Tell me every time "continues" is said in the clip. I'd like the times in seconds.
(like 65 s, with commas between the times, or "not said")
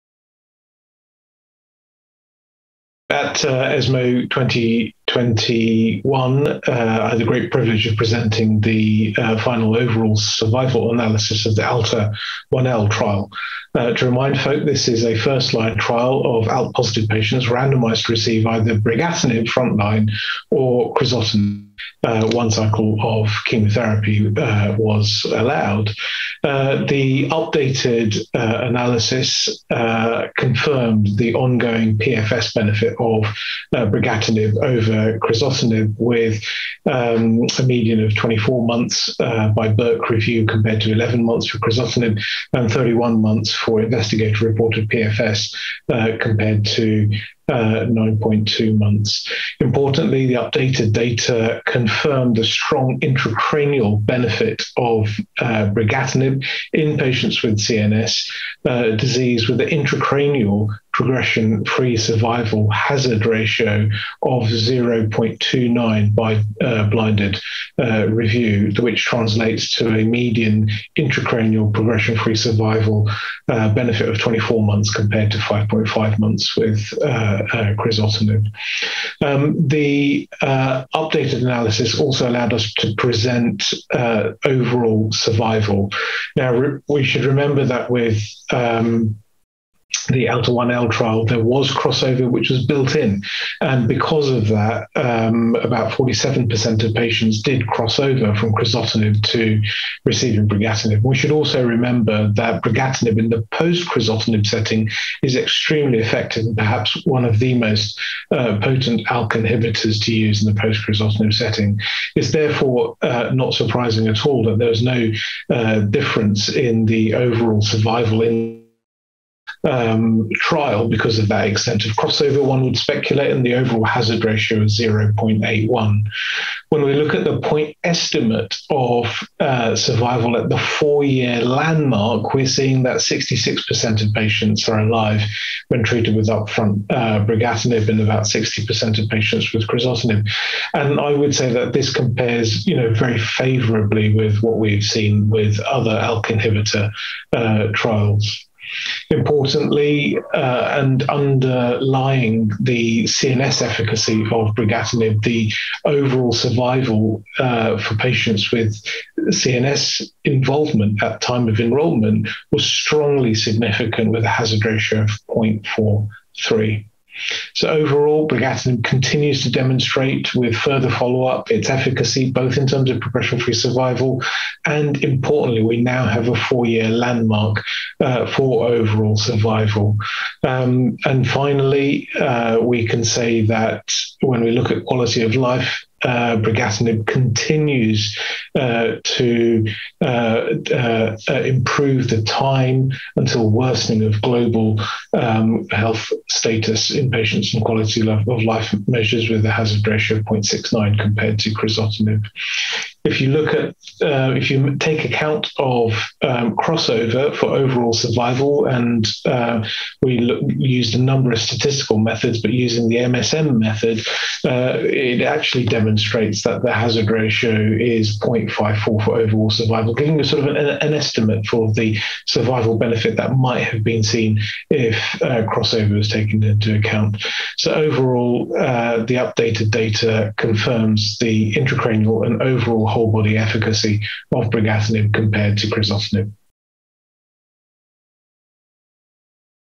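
168 s, 187 s.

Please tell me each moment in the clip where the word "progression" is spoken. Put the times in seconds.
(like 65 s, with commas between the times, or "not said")
61 s, 71 s, 173 s.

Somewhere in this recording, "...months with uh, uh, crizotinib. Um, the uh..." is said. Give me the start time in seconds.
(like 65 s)
76 s.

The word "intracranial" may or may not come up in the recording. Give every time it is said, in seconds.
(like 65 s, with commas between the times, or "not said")
53 s, 59 s, 70 s, 231 s.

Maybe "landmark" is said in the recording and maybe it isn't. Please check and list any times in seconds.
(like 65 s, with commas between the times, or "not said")
131 s, 176 s.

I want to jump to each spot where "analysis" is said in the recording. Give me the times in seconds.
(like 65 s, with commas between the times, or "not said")
10 s, 28 s, 81 s.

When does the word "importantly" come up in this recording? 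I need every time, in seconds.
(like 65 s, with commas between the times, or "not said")
49 s, 149 s, 175 s.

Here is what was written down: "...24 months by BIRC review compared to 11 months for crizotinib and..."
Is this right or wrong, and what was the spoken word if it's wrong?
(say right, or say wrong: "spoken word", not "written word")
right.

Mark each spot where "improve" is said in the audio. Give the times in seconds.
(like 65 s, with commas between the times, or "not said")
191 s.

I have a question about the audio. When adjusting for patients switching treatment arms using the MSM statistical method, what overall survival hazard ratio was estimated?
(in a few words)
0.54.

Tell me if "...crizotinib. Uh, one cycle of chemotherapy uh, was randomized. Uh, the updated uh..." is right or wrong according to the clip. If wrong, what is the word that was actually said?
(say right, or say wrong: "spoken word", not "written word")
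wrong: "allowed", not "randomized".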